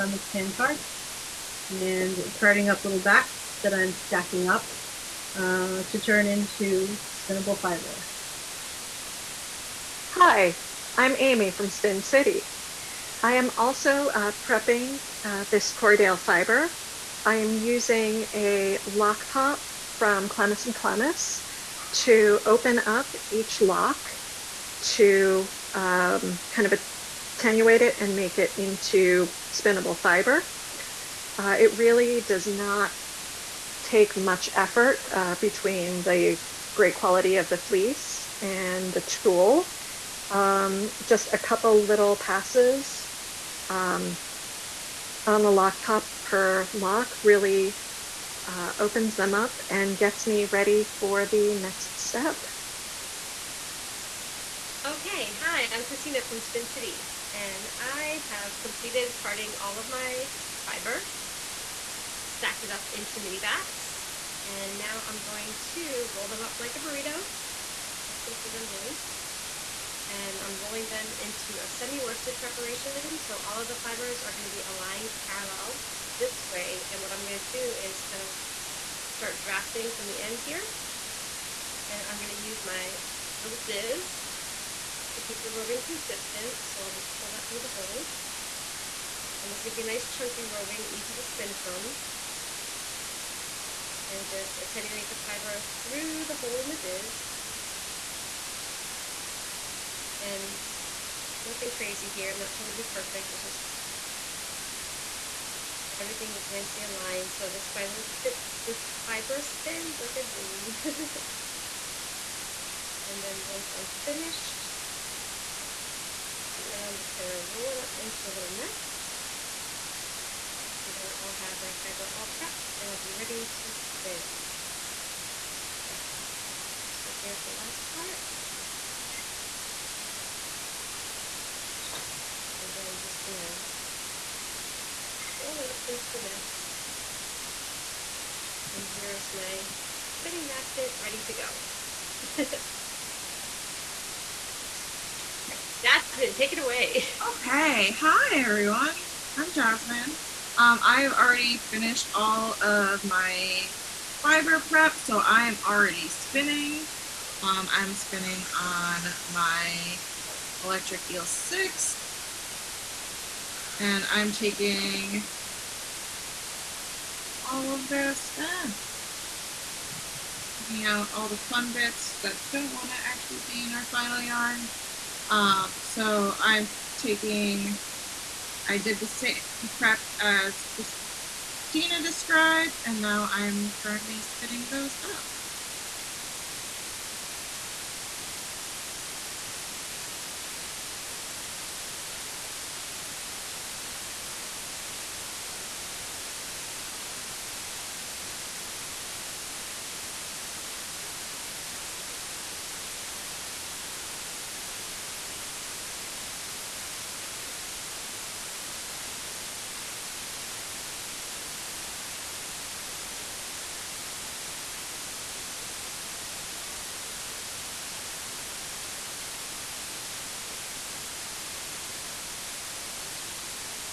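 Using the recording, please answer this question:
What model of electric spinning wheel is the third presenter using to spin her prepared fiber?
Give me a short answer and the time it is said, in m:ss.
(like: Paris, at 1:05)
Electric Eel 6, at 2:40.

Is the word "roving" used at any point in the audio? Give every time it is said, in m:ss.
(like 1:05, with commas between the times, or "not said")
1:25, 1:30.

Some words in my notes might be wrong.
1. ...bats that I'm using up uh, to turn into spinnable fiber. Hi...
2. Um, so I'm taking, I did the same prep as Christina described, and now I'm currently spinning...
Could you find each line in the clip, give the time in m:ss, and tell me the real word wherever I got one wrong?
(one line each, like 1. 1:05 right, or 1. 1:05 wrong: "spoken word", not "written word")
1. 0:02 wrong: "stacking", not "using"
2. 2:55 right.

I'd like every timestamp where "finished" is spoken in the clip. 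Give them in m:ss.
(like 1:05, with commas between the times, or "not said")
1:54, 2:31.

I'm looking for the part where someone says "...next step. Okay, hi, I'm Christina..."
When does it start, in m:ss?
0:51.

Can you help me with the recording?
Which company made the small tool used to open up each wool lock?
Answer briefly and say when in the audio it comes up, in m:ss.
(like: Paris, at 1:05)
Clemes and Clemes, at 0:20.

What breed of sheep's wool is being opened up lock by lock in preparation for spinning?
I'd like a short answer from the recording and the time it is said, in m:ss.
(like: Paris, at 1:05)
Corriedale, at 0:15.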